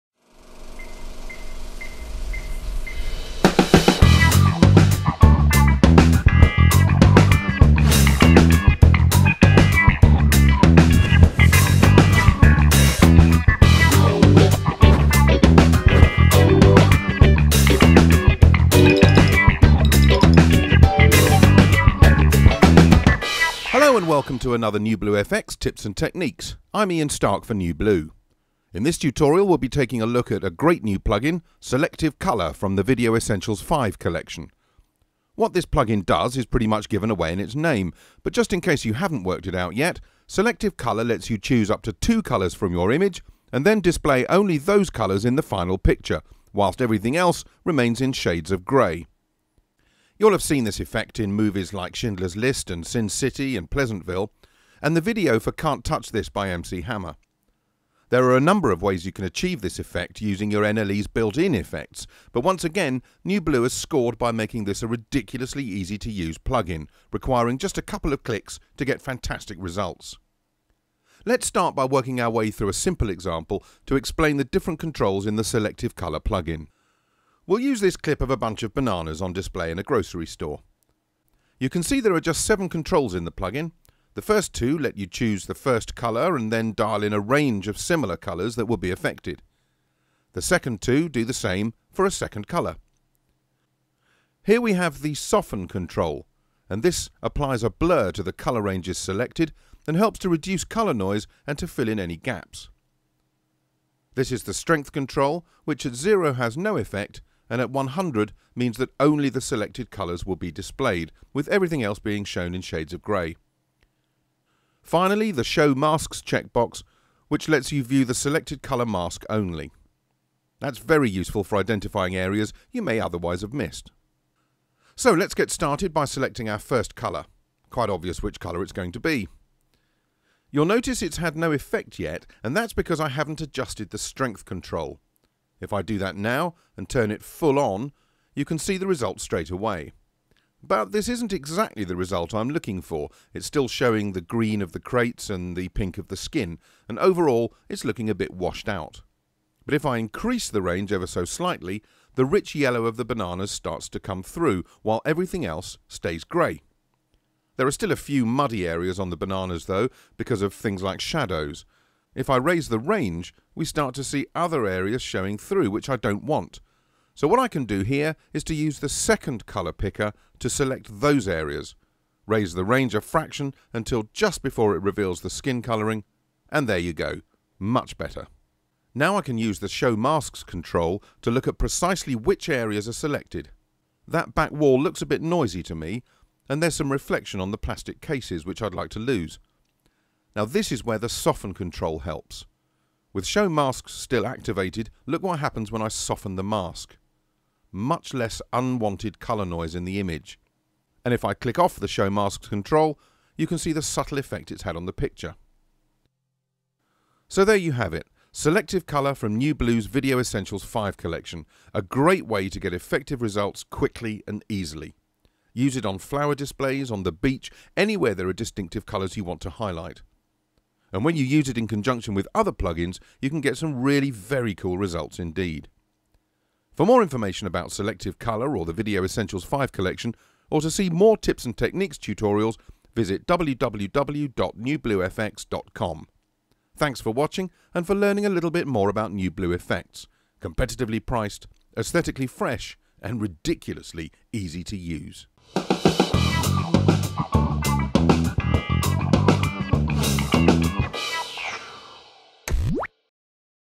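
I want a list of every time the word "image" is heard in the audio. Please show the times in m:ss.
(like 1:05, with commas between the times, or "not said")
0:42, 3:19.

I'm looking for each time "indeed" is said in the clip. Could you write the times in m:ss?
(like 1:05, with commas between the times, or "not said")
3:45.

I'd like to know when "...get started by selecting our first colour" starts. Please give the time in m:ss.
2:05.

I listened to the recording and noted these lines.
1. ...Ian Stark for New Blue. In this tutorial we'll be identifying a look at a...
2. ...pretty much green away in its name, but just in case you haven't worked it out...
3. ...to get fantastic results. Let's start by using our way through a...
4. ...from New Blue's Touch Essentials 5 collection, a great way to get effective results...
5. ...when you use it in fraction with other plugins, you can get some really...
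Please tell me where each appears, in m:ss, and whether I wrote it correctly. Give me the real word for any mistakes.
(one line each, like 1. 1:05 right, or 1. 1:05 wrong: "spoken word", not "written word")
1. 0:26 wrong: "taking", not "identifying"
2. 0:36 wrong: "given", not "green"
3. 1:08 wrong: "working", not "using"
4. 3:29 wrong: "Video", not "Touch"
5. 3:41 wrong: "conjunction", not "fraction".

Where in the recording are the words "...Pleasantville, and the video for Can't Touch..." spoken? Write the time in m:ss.
0:53.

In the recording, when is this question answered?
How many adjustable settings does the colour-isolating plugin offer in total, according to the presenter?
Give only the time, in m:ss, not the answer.
1:22.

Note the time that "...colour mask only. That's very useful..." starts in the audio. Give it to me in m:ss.
1:58.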